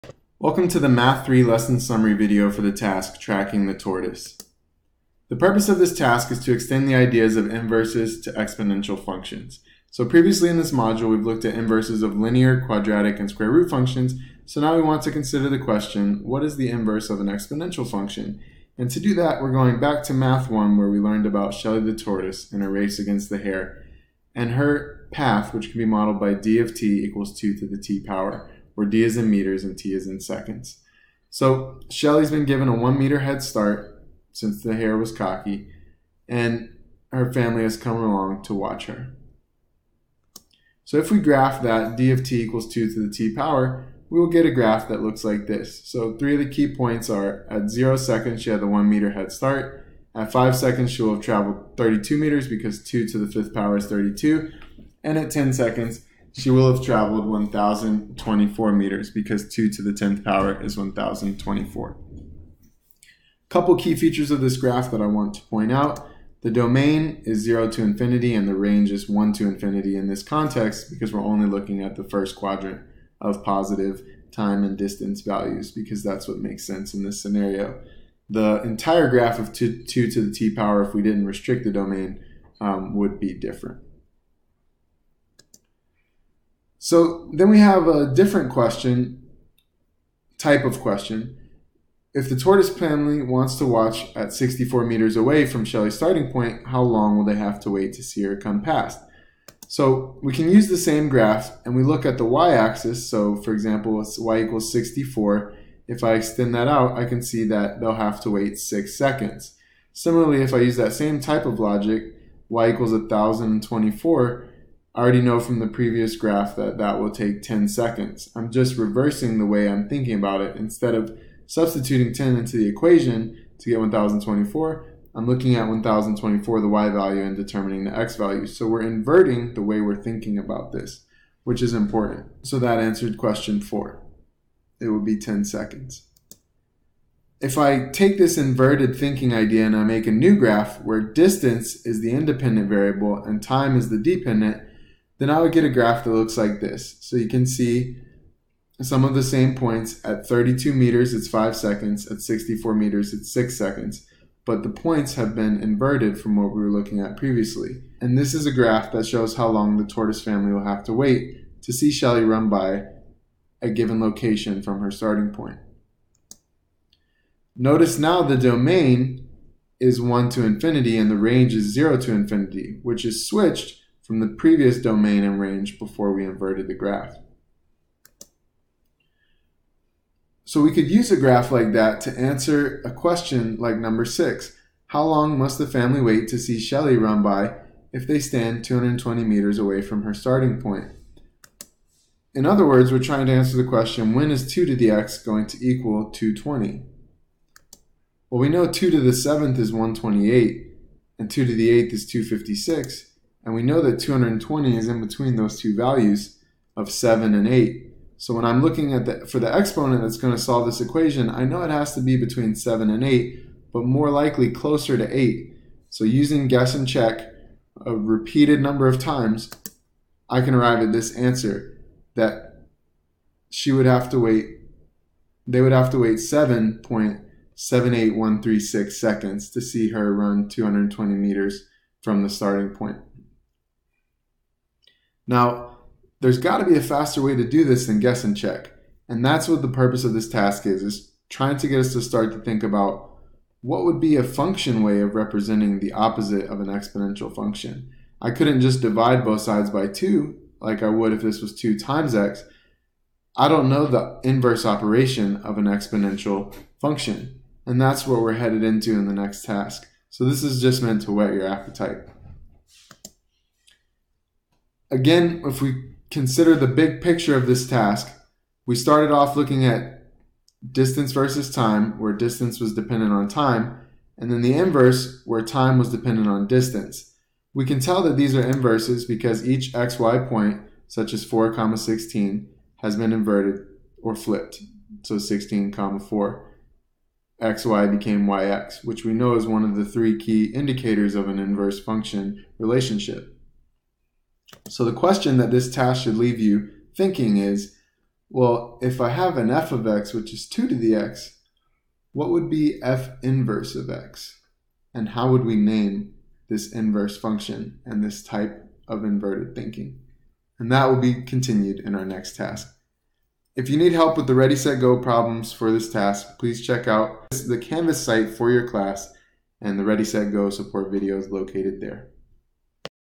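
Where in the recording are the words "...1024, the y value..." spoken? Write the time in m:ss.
2:05.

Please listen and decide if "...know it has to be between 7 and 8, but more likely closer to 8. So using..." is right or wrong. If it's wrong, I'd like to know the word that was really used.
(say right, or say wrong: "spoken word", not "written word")
right.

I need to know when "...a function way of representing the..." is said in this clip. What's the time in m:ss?
4:04.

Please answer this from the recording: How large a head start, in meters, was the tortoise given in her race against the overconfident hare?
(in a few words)
1 meter.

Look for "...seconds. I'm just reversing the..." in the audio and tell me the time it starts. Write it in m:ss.
1:57.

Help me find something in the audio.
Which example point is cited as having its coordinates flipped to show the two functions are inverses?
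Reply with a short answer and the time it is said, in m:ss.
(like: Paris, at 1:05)
(4, 16), at 4:41.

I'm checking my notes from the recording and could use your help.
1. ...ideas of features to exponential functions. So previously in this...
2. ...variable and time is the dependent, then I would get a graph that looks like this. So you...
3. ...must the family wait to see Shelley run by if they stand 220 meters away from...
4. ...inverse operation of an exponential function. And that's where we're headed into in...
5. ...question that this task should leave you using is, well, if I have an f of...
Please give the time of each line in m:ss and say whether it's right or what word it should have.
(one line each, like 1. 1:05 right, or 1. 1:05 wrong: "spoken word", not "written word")
1. 0:06 wrong: "inverses", not "features"
2. 2:22 right
3. 3:05 right
4. 4:14 right
5. 4:54 wrong: "thinking", not "using".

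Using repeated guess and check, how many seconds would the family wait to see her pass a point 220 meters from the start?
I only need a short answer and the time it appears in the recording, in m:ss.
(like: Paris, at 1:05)
7.78136 seconds, at 3:46.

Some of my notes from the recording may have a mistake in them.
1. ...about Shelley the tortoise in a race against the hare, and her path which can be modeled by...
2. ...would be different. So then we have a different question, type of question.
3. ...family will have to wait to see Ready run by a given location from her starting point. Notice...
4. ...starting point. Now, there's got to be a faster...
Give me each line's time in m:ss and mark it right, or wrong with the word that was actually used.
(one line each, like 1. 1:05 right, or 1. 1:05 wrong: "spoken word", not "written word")
1. 0:21 right
2. 1:22 right
3. 2:40 wrong: "Shelly", not "Ready"
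4. 3:52 right.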